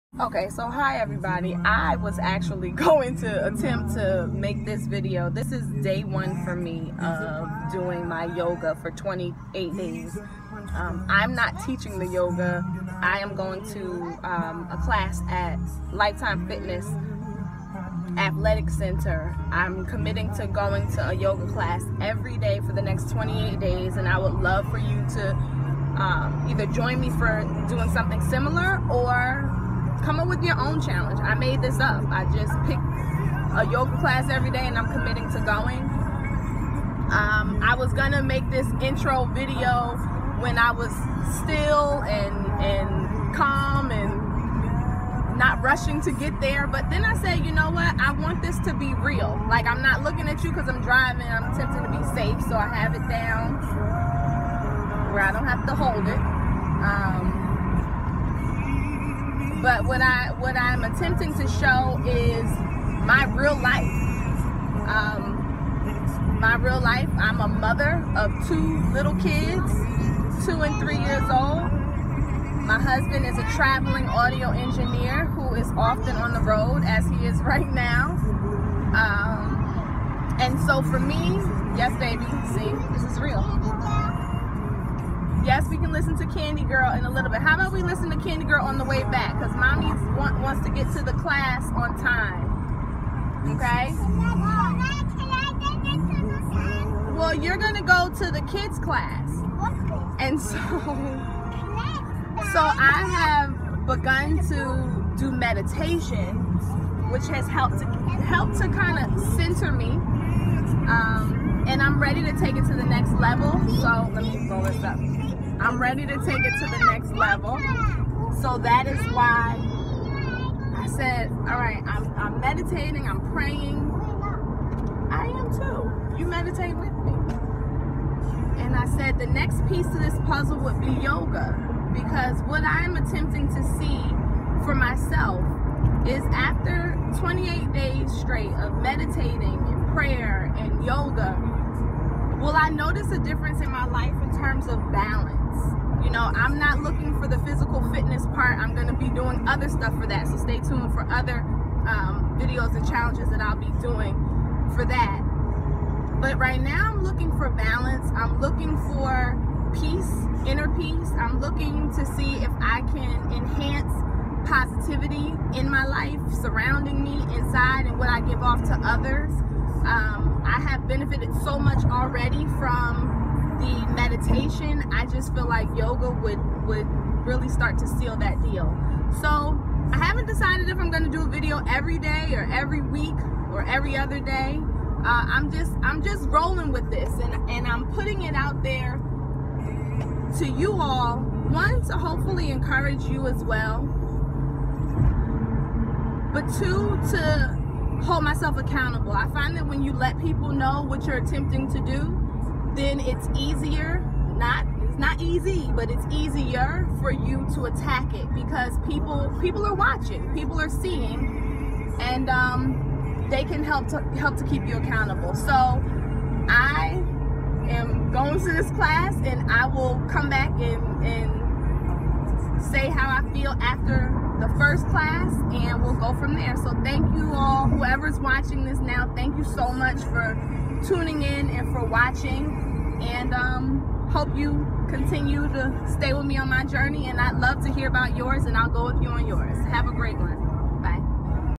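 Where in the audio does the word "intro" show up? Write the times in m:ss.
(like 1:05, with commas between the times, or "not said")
0:38.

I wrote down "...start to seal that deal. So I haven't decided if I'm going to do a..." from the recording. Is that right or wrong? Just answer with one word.
right.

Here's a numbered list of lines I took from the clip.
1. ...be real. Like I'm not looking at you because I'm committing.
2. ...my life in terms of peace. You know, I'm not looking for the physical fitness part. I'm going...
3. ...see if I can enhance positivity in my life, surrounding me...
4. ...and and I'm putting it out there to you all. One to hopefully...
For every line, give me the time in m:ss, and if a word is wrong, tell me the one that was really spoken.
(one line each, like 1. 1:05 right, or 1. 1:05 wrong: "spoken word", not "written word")
1. 0:48 wrong: "driving", not "committing"
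2. 2:23 wrong: "balance", not "peace"
3. 2:42 right
4. 3:07 right.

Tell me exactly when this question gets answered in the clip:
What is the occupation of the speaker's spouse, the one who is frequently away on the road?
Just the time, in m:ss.
1:14.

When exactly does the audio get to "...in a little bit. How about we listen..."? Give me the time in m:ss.
1:26.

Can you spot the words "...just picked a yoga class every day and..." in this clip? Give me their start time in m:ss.
0:32.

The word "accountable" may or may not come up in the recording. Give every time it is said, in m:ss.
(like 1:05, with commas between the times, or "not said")
3:18, 3:34.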